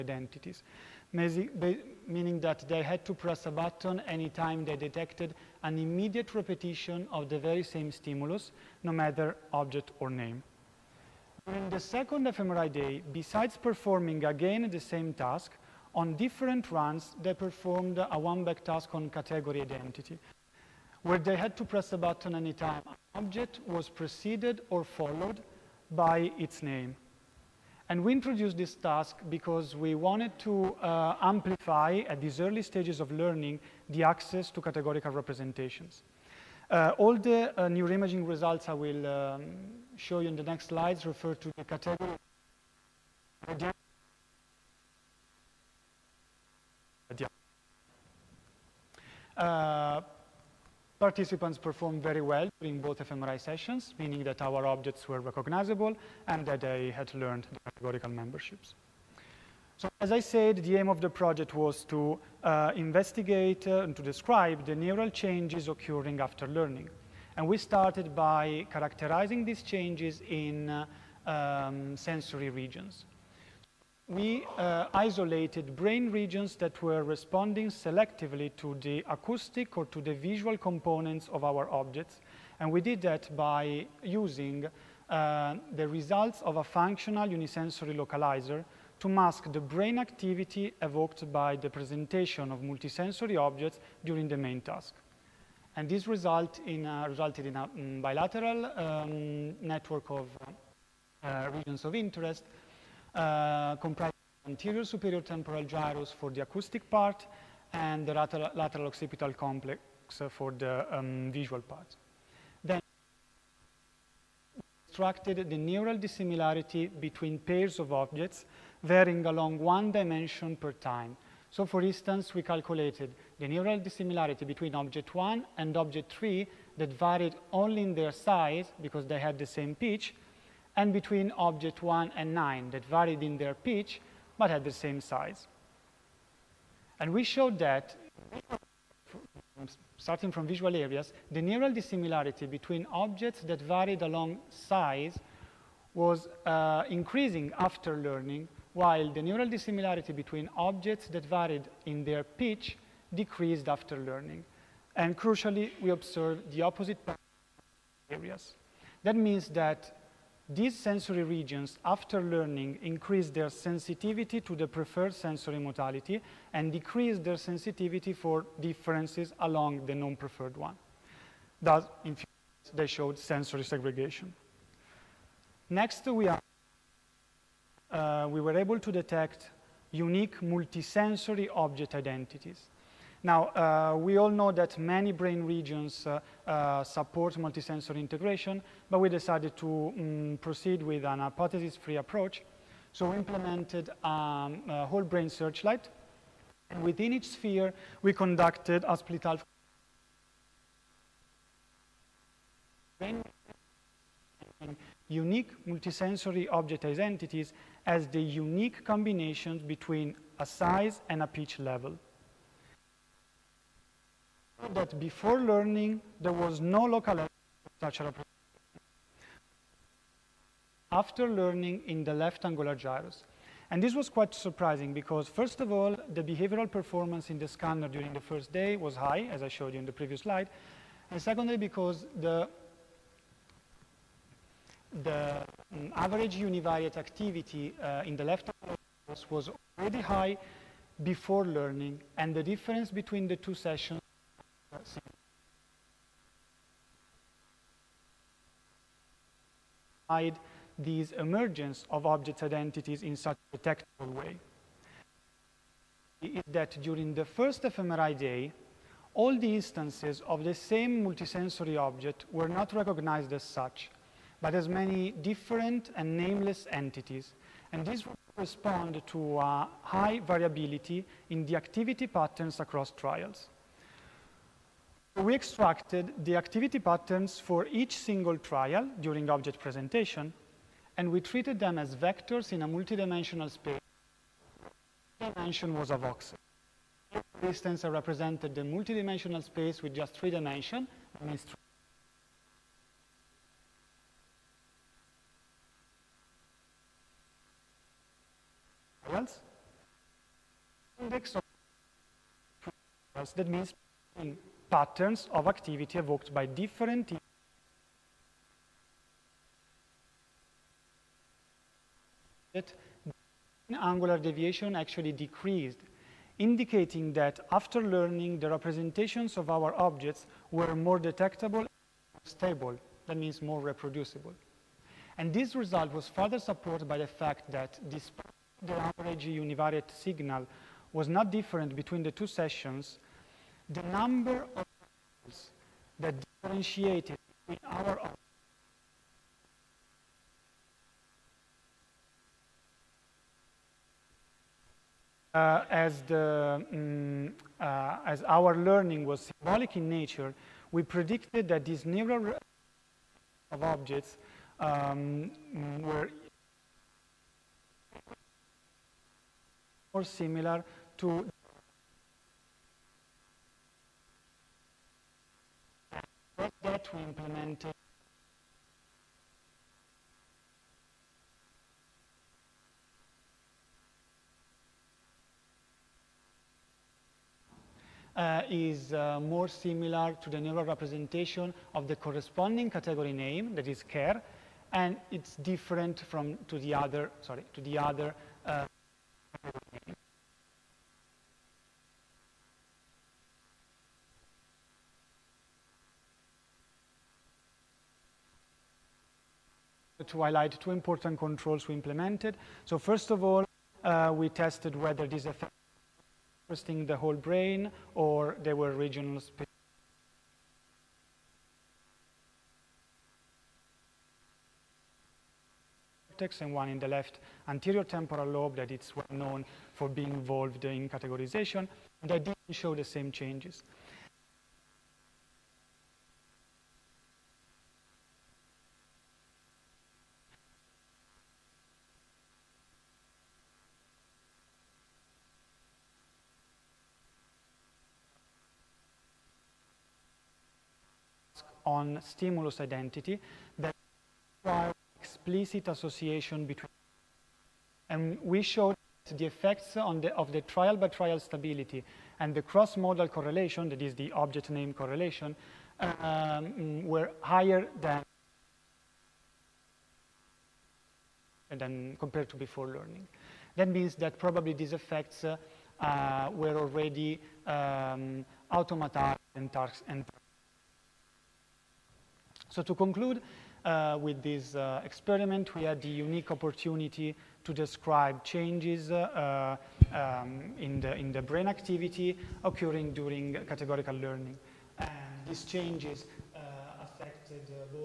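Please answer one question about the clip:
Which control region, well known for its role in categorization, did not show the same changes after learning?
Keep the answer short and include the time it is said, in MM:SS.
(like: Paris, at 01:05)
Left anterior temporal lobe, at 06:56.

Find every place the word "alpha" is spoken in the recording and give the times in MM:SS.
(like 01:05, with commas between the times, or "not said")
03:19.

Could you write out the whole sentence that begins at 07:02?
I didn't show the same changes.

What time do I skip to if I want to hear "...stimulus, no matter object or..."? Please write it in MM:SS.
00:07.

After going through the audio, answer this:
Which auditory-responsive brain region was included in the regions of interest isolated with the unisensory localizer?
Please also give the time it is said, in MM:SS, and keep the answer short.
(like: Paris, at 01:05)
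Anterior superior temporal gyrus, at 01:44.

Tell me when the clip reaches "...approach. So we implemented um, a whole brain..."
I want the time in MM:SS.
03:11.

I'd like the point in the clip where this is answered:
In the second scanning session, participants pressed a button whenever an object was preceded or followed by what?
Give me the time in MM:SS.
00:26.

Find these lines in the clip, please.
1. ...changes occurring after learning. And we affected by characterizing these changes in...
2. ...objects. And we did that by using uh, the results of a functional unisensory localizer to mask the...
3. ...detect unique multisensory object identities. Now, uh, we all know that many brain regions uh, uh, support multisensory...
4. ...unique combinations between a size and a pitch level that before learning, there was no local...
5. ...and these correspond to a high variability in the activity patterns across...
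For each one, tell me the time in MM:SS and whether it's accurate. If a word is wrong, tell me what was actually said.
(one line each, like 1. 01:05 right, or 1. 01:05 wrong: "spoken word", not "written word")
1. 01:05 wrong: "started", not "affected"
2. 01:21 right
3. 02:58 right
4. 03:28 right
5. 04:27 right.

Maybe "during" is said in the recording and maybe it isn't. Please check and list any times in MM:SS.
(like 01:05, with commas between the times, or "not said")
00:11, 00:52, 01:34, 03:47, 04:16, 04:39, 08:02.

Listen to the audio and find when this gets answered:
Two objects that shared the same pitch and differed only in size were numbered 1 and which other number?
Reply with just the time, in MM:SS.
02:05.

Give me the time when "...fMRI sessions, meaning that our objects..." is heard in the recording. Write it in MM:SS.
00:53.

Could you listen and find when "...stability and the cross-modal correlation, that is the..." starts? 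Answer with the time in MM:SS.
07:31.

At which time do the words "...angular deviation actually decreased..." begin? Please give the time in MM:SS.
05:13.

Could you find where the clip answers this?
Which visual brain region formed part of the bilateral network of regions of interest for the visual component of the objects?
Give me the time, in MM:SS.
01:48.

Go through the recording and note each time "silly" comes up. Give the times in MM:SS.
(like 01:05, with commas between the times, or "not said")
not said.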